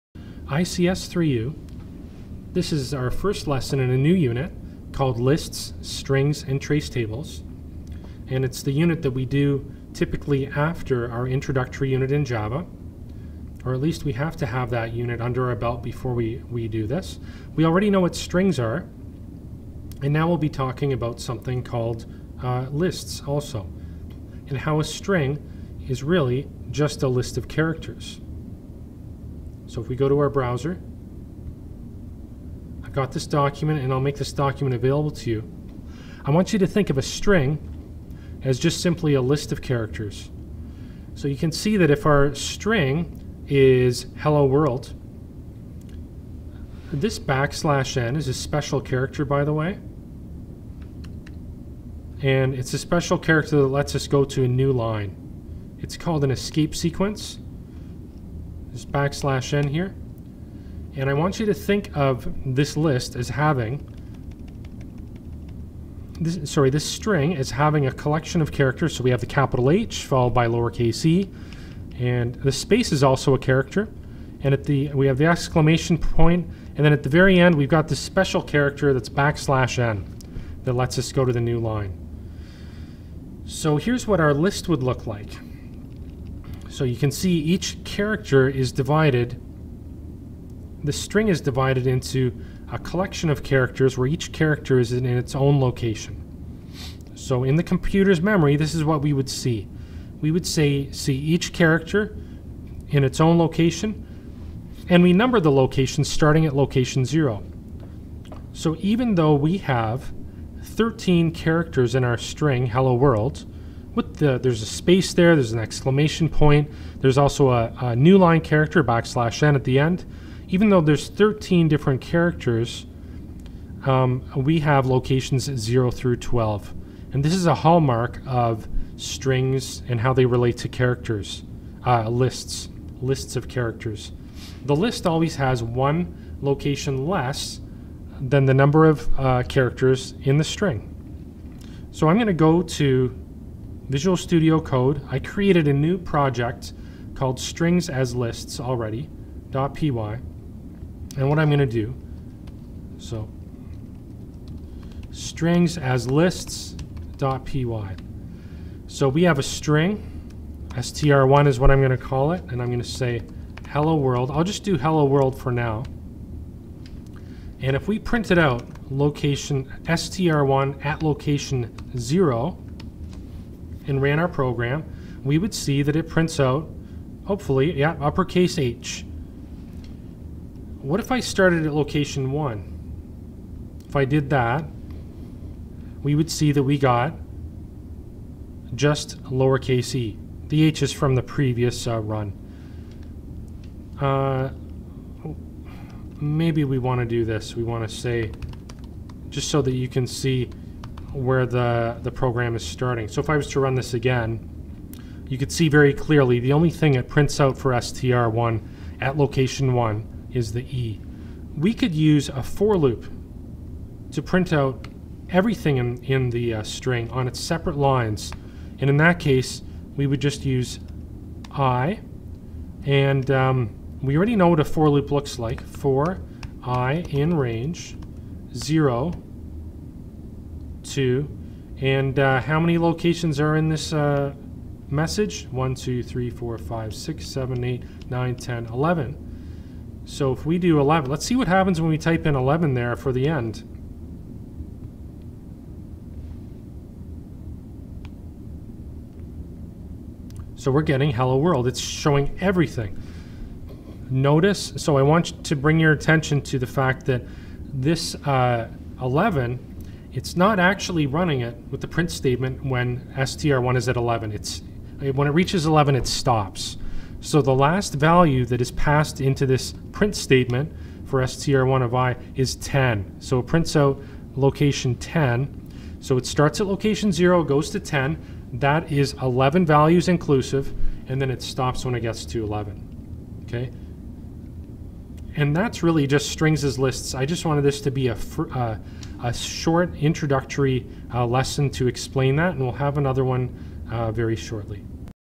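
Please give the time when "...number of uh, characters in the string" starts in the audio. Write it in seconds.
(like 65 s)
138 s.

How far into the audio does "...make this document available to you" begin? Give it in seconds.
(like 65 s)
34 s.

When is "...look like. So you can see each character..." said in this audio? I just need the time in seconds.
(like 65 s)
84 s.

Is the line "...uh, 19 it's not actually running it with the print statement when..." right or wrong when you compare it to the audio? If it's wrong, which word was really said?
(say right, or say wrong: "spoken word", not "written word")
wrong: "11", not "19".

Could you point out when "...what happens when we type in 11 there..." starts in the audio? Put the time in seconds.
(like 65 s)
241 s.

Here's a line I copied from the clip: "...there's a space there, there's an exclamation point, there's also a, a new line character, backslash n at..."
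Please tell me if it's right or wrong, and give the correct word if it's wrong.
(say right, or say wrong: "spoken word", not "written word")
right.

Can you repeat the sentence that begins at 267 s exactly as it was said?
So the last value that is passed into this print statement for str1 of i is 10.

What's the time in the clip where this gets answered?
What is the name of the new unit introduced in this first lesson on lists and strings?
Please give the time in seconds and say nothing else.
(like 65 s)
5 s.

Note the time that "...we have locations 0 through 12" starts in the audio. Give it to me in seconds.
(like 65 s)
124 s.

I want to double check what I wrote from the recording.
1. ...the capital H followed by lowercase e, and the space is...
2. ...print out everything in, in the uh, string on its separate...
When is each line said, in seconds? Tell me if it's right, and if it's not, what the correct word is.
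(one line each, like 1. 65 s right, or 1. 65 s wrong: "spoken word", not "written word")
1. 69 s right
2. 214 s right.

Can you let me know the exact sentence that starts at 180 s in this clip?
What if I started at location 1?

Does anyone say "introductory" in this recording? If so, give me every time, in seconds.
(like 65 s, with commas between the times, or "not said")
11 s, 289 s.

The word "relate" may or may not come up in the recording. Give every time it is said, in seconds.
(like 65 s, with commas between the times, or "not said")
130 s.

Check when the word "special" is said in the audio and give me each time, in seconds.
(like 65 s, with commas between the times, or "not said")
48 s, 52 s, 77 s.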